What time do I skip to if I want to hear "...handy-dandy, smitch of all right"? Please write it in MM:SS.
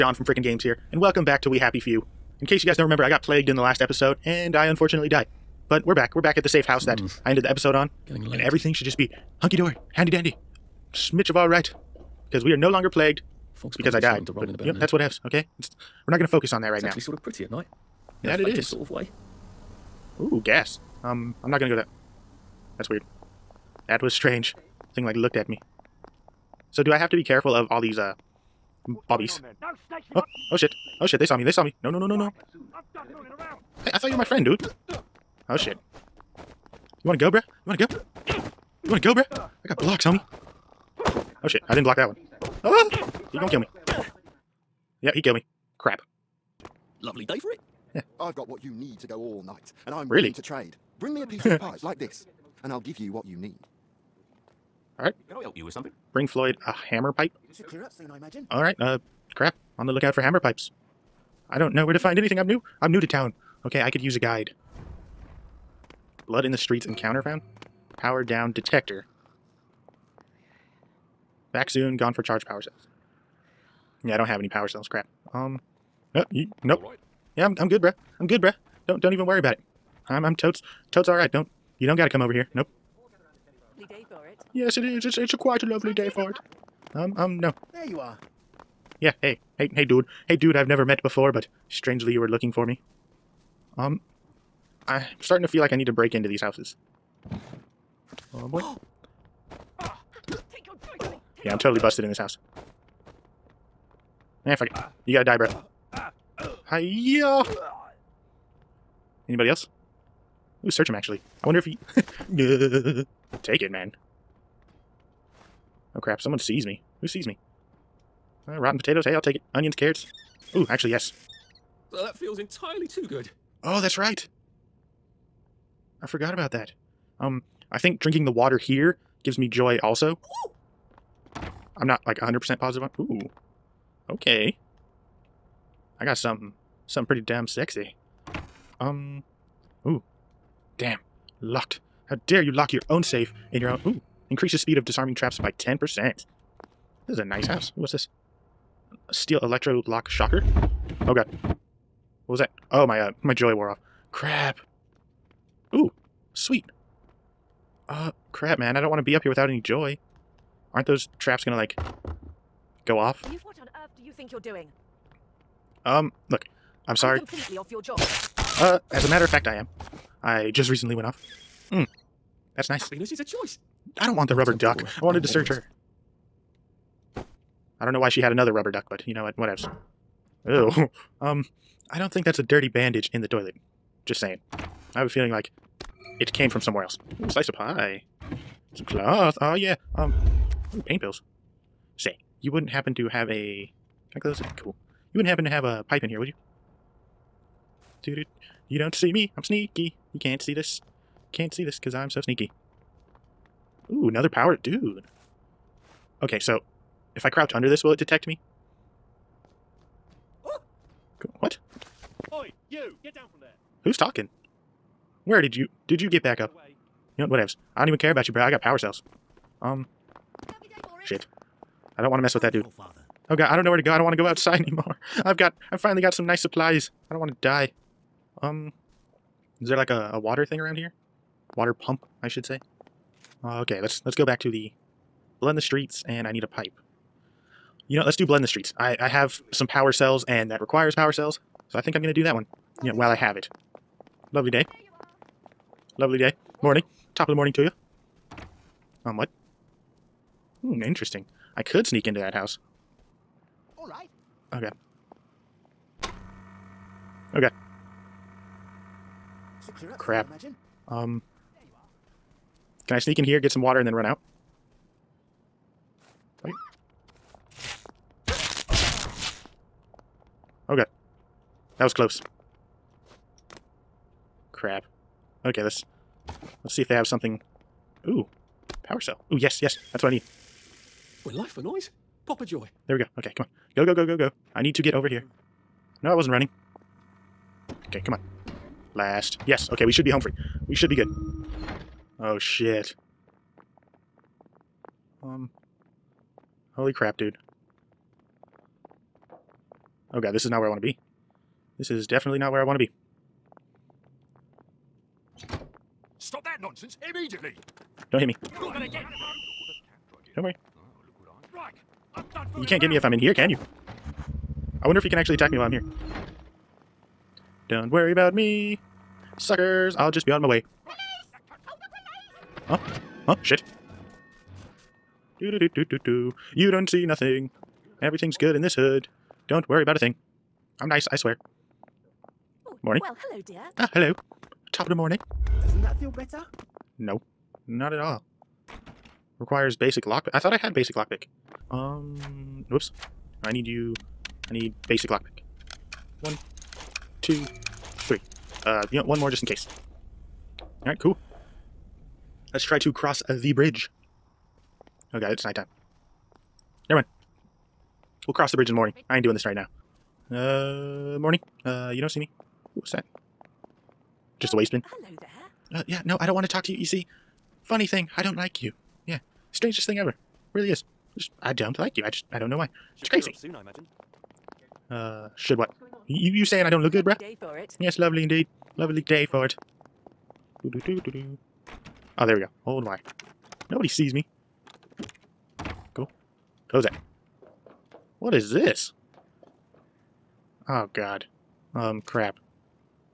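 00:09.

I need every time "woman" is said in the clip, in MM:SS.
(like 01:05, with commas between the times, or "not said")
not said.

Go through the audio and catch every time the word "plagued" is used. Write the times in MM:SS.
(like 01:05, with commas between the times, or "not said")
00:03, 00:12.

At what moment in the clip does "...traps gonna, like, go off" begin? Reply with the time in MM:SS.
02:41.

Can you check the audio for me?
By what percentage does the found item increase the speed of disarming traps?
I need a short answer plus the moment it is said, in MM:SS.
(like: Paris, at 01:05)
10%, at 02:25.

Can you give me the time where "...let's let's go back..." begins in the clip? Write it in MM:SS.
03:53.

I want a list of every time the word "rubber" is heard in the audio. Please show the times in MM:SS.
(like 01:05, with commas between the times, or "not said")
02:54, 02:58.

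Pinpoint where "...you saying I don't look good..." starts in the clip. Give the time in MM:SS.
06:16.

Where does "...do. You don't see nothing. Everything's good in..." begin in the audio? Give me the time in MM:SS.
05:26.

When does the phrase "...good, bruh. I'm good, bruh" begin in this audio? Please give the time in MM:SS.
01:17.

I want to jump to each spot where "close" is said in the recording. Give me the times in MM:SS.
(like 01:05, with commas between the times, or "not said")
03:14, 04:31, 06:26.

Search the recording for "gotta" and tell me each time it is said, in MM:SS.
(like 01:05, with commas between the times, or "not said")
01:45.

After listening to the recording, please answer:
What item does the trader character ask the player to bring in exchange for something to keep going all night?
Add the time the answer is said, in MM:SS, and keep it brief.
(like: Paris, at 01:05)
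Hammer pipe, at 00:56.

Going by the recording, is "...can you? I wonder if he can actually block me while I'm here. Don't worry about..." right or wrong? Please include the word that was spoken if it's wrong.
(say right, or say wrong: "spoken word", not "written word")
wrong: "attack", not "block".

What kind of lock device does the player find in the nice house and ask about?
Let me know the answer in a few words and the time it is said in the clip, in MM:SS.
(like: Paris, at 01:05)
Steel electro lock shocker, at 02:29.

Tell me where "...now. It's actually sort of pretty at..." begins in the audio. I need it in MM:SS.
00:16.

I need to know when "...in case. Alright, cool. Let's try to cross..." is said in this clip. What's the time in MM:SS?
05:49.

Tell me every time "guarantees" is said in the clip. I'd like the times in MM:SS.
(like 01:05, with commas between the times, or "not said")
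not said.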